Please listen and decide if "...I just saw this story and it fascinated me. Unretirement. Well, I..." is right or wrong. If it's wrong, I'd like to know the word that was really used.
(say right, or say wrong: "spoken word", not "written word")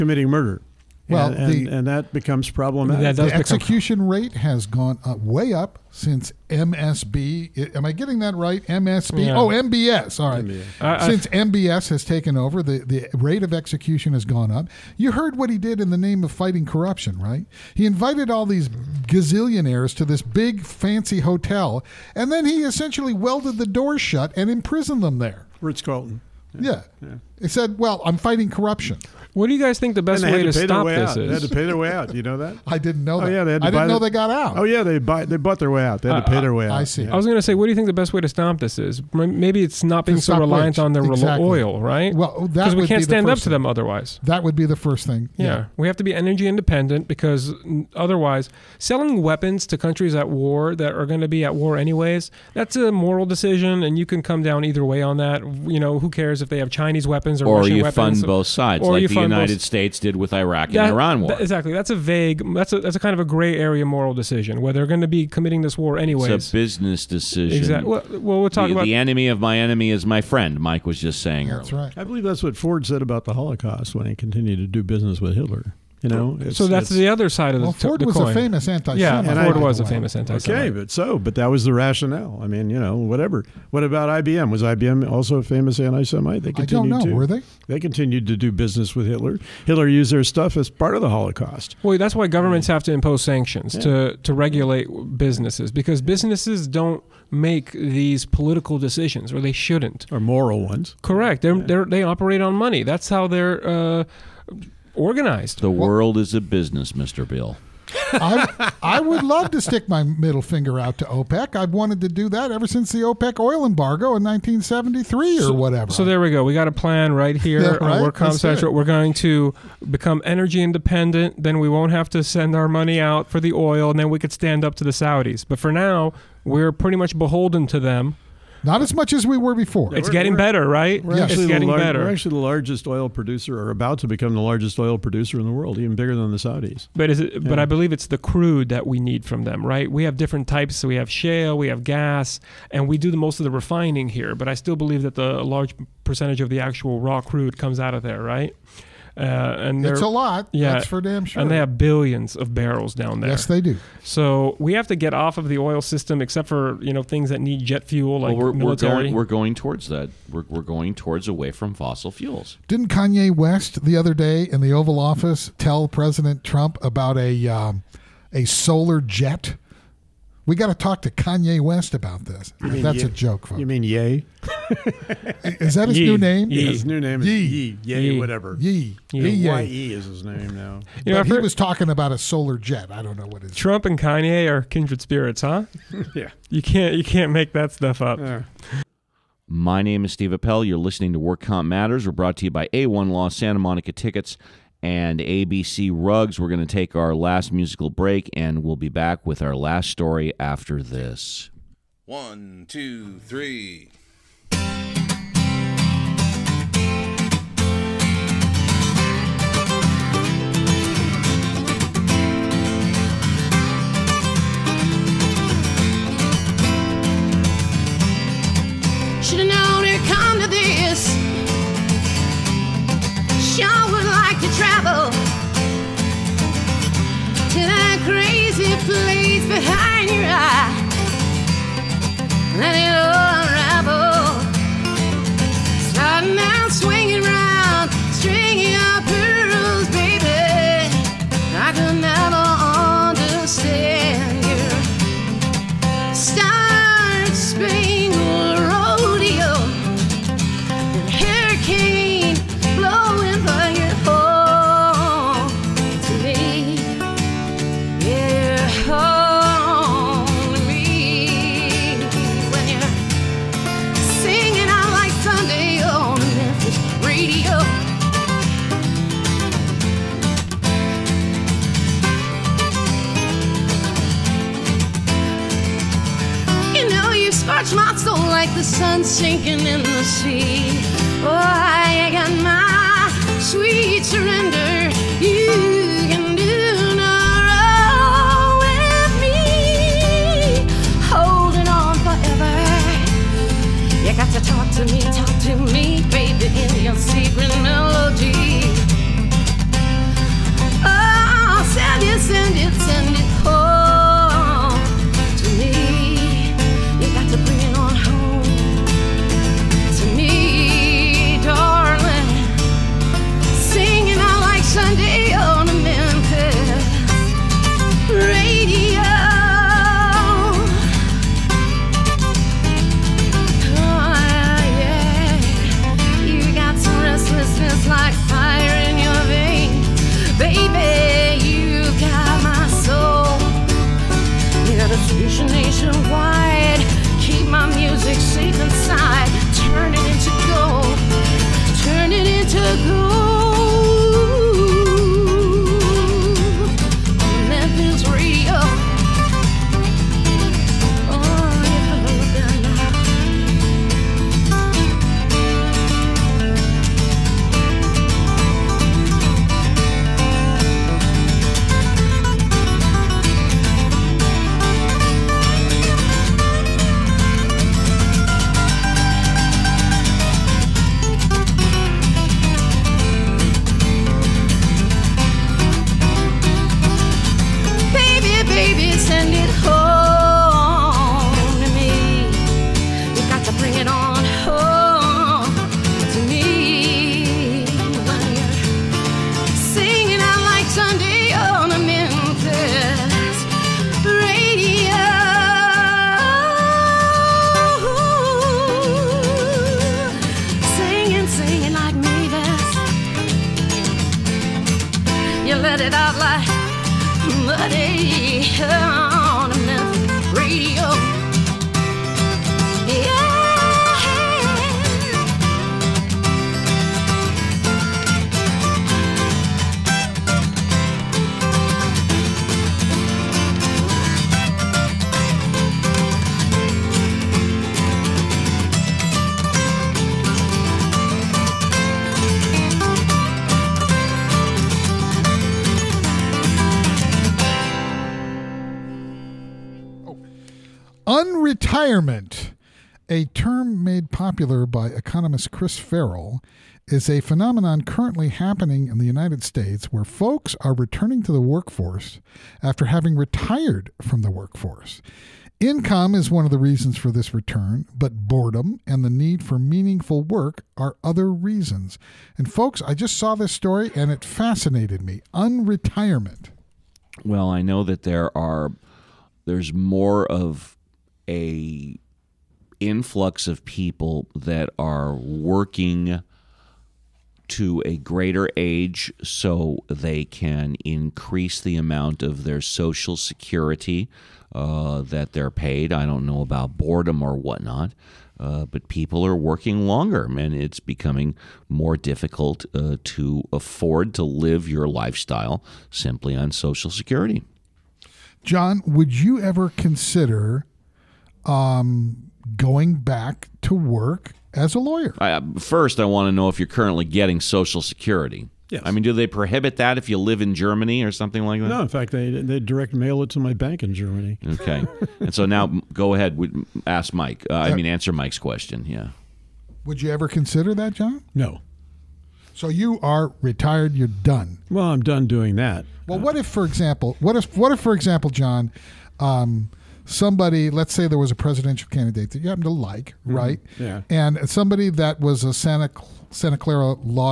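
right.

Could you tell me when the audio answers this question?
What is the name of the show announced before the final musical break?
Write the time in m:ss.
3:11.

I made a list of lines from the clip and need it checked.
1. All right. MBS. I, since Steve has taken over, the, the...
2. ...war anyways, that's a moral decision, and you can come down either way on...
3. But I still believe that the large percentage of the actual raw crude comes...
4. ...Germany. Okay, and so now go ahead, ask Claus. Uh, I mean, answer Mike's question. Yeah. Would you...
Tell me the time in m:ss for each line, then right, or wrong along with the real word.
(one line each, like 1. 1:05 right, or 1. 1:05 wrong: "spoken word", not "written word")
1. 0:10 wrong: "MBS", not "Steve"
2. 0:51 right
3. 2:24 right
4. 8:33 wrong: "Mike", not "Claus".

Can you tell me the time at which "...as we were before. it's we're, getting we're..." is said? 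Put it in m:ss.
2:09.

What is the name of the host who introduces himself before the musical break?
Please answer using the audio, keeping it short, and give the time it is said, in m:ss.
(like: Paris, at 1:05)
Steve Appel, at 3:10.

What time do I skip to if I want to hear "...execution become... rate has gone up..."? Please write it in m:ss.
0:03.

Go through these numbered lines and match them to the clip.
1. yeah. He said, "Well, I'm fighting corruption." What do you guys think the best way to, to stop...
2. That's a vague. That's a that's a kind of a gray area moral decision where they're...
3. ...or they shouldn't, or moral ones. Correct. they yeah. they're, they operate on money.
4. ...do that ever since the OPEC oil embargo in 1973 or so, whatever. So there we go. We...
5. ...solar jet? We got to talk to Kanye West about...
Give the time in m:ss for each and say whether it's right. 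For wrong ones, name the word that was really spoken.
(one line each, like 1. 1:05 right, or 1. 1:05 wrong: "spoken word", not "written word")
1. 0:27 right
2. 1:01 right
3. 1:39 right
4. 1:52 right
5. 2:48 right.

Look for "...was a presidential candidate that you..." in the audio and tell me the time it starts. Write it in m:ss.
8:51.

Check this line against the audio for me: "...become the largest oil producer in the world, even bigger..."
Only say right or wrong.
right.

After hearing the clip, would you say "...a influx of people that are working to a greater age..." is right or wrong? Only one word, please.
right.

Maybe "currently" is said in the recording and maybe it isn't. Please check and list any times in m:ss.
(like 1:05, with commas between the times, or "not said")
7:27, 8:26.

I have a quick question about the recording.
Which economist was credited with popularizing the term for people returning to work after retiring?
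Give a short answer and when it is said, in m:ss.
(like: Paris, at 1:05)
Chris Farrell, at 7:25.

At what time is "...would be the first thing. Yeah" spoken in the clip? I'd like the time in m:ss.
0:44.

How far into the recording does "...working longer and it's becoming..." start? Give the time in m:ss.
8:09.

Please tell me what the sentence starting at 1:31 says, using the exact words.
Well, that's why governments have to impose sanctions yeah.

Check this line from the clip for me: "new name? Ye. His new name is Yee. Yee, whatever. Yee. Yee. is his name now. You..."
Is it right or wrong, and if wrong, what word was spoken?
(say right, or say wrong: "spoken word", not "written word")
right.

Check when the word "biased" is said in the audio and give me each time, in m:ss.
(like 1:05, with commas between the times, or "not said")
not said.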